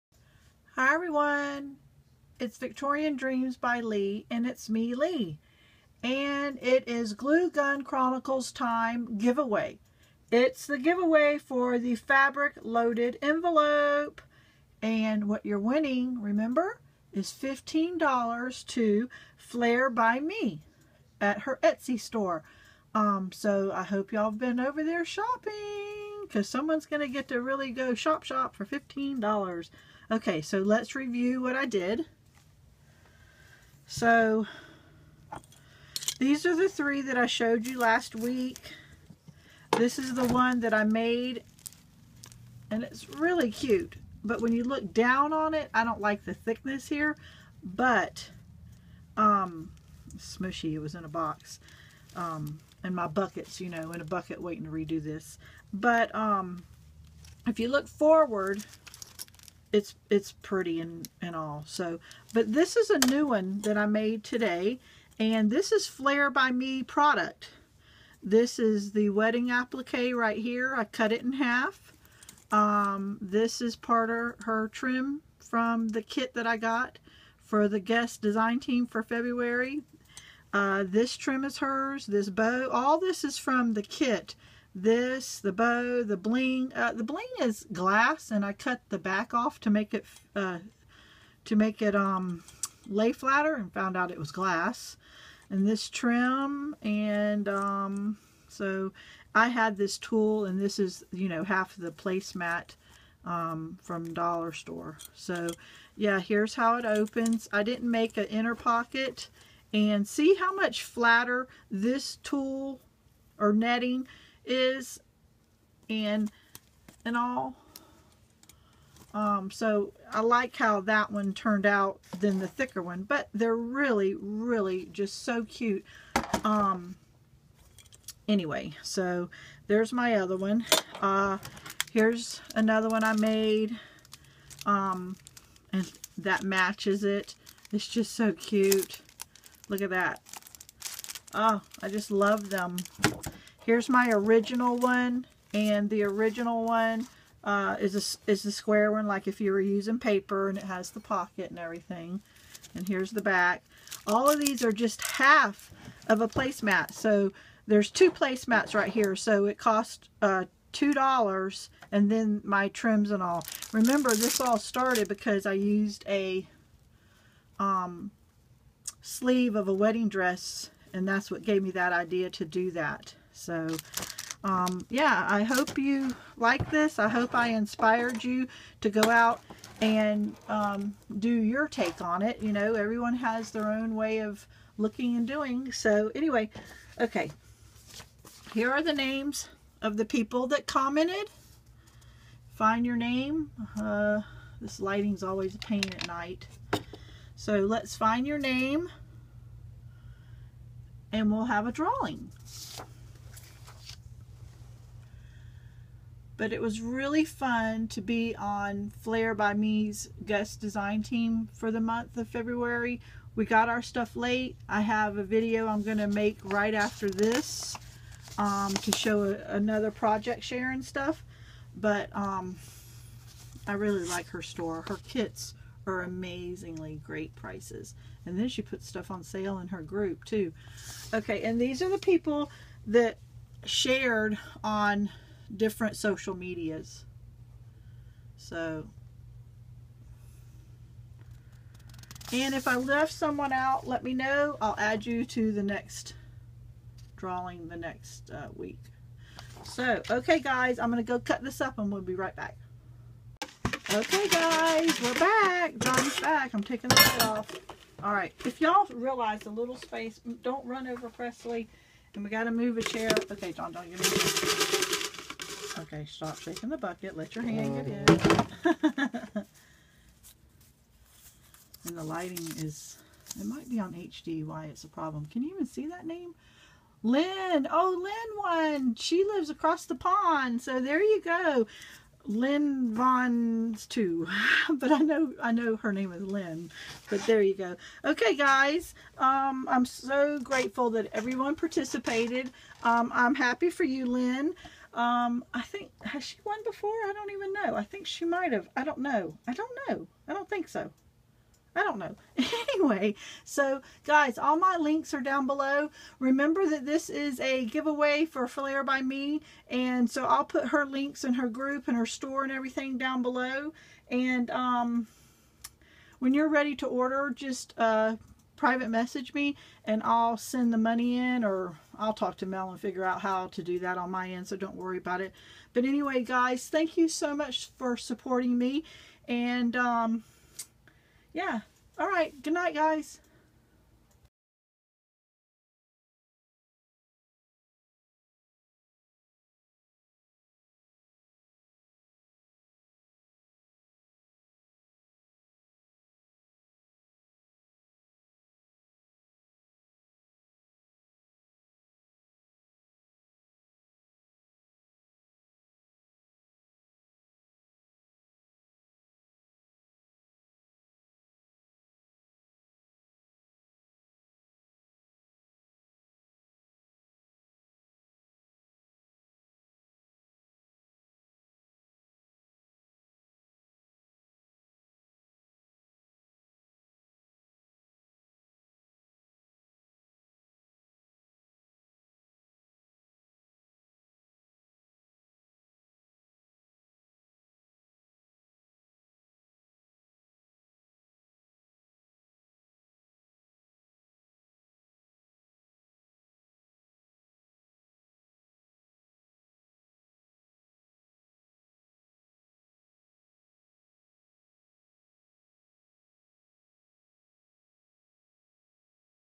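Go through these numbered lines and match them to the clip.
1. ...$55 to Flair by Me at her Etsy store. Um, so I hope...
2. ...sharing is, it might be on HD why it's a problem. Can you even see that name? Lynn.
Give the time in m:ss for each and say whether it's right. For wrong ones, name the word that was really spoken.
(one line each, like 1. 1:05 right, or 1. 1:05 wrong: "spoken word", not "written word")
1. 0:17 wrong: "15", not "55"
2. 4:32 wrong: "lighting", not "sharing".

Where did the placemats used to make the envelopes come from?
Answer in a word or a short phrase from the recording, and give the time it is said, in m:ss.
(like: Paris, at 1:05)
Dollar Store, at 1:44.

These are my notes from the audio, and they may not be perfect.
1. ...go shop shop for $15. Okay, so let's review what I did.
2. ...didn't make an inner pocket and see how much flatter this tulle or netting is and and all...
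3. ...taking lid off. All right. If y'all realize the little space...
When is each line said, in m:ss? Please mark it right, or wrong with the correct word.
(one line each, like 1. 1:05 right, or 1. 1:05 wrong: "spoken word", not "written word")
1. 0:27 right
2. 1:47 right
3. 4:16 right.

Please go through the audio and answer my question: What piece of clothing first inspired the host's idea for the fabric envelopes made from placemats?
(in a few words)
Sleeve of a wedding dress.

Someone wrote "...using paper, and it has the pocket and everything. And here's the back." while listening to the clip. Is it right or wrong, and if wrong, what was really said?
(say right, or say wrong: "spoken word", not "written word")
right.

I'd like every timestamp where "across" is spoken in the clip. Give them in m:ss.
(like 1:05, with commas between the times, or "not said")
4:39.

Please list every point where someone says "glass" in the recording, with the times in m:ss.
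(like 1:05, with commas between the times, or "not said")
1:27, 1:34.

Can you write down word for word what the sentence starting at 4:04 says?
I'll add you to the next drawing the next uh, week.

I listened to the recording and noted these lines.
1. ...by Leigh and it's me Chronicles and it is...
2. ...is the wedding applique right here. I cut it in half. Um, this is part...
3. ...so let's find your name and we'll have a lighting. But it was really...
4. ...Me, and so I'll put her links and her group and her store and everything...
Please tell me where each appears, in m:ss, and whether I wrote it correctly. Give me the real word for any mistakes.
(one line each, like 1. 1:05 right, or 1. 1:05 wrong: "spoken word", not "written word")
1. 0:03 wrong: "Leigh", not "Chronicles"
2. 1:08 right
3. 3:17 wrong: "drawing", not "lighting"
4. 5:09 right.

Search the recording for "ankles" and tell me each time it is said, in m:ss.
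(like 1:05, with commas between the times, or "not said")
not said.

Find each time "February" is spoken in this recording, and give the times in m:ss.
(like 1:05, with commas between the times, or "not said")
1:19, 3:32.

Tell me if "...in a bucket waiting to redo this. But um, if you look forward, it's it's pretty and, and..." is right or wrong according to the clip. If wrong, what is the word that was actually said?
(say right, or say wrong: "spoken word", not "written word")
right.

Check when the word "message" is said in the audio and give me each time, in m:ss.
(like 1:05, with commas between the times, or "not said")
5:18.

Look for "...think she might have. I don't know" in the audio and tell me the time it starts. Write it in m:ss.
4:57.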